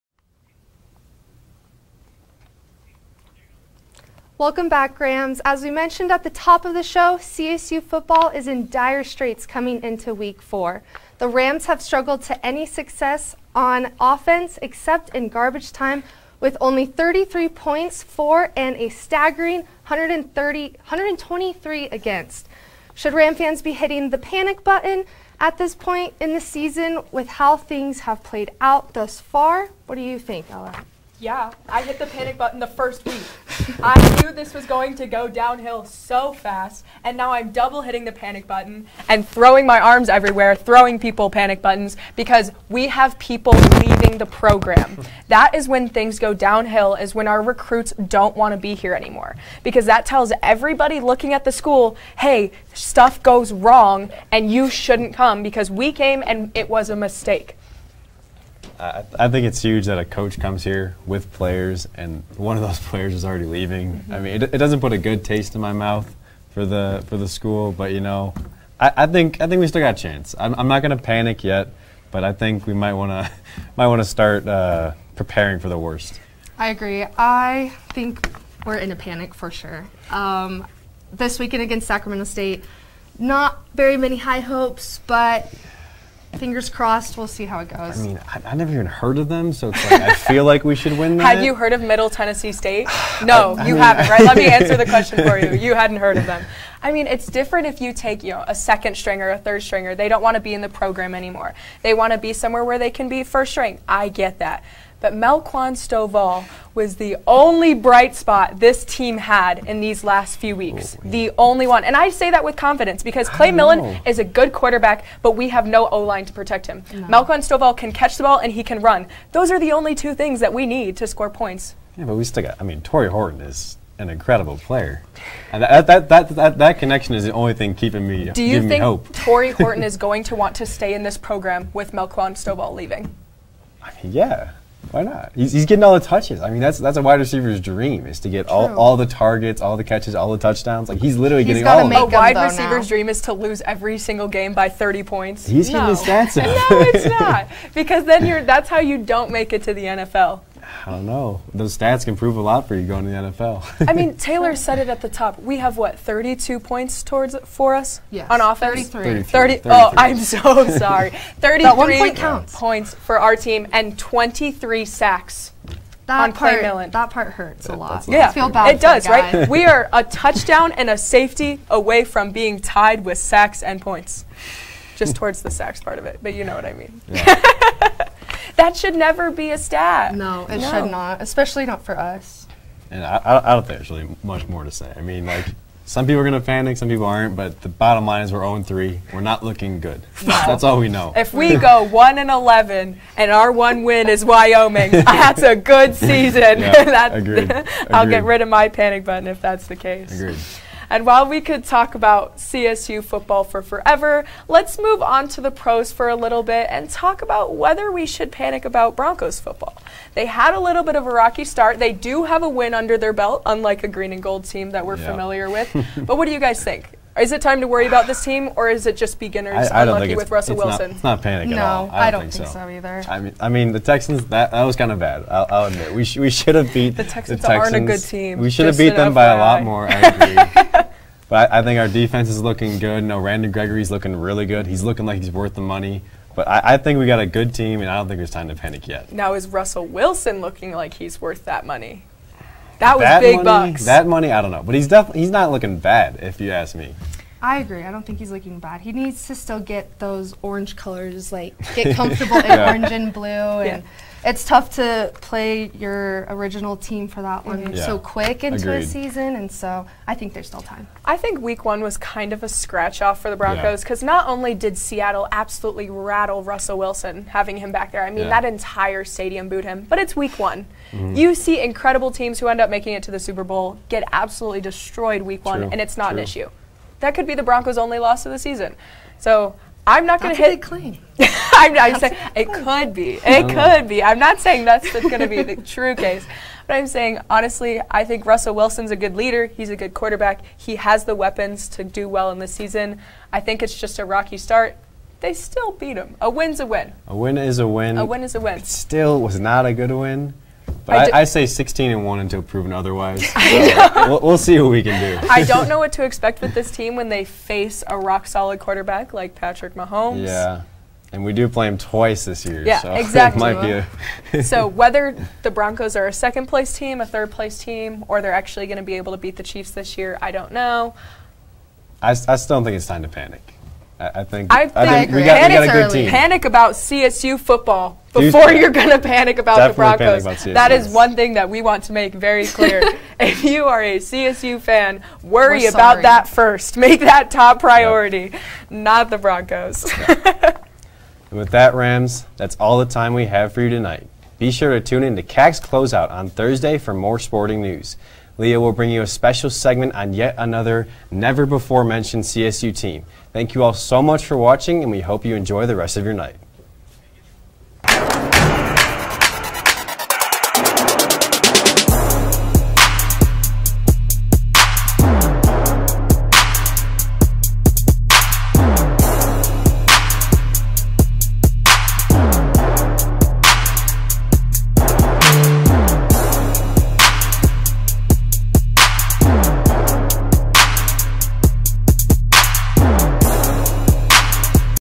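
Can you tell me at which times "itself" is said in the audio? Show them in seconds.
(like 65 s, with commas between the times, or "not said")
not said.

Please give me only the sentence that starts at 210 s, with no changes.
They had a little bit of a rocky start.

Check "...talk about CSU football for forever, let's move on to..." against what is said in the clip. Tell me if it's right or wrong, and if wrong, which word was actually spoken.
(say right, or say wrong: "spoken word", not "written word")
right.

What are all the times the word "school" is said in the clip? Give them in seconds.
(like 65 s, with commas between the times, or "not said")
51 s, 67 s.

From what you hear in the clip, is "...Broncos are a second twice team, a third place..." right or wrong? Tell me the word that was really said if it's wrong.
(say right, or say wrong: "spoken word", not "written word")
wrong: "place", not "twice".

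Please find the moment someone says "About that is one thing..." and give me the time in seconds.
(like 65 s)
330 s.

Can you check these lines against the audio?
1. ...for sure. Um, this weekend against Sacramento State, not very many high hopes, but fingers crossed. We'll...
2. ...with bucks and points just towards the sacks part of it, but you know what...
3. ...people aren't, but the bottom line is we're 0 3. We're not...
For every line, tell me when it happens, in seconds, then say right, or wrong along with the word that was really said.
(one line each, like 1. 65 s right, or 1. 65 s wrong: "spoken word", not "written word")
1. 79 s right
2. 173 s wrong: "sacks", not "bucks"
3. 186 s right.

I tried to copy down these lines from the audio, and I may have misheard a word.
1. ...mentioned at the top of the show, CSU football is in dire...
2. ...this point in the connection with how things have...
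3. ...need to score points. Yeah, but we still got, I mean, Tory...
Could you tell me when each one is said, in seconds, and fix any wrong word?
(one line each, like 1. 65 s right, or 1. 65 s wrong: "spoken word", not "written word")
1. 5 s right
2. 25 s wrong: "season", not "connection"
3. 120 s right.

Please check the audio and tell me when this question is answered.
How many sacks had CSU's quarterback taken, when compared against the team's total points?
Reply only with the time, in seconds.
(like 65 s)
163 s.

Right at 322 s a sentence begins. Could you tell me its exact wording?
I, I still don't think it's time to panic.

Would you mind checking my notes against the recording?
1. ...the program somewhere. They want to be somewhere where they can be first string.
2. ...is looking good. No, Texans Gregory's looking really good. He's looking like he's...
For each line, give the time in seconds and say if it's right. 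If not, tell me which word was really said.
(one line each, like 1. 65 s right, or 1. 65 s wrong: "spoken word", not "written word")
1. 100 s wrong: "anymore", not "somewhere"
2. 232 s wrong: "Brandon", not "Texans".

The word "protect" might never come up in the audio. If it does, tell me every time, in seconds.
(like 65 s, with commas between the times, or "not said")
116 s.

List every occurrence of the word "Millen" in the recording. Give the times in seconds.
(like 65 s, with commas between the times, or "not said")
113 s, 166 s.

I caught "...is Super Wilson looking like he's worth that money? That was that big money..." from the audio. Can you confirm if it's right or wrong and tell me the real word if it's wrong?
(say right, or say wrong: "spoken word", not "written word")
wrong: "Russell", not "Super".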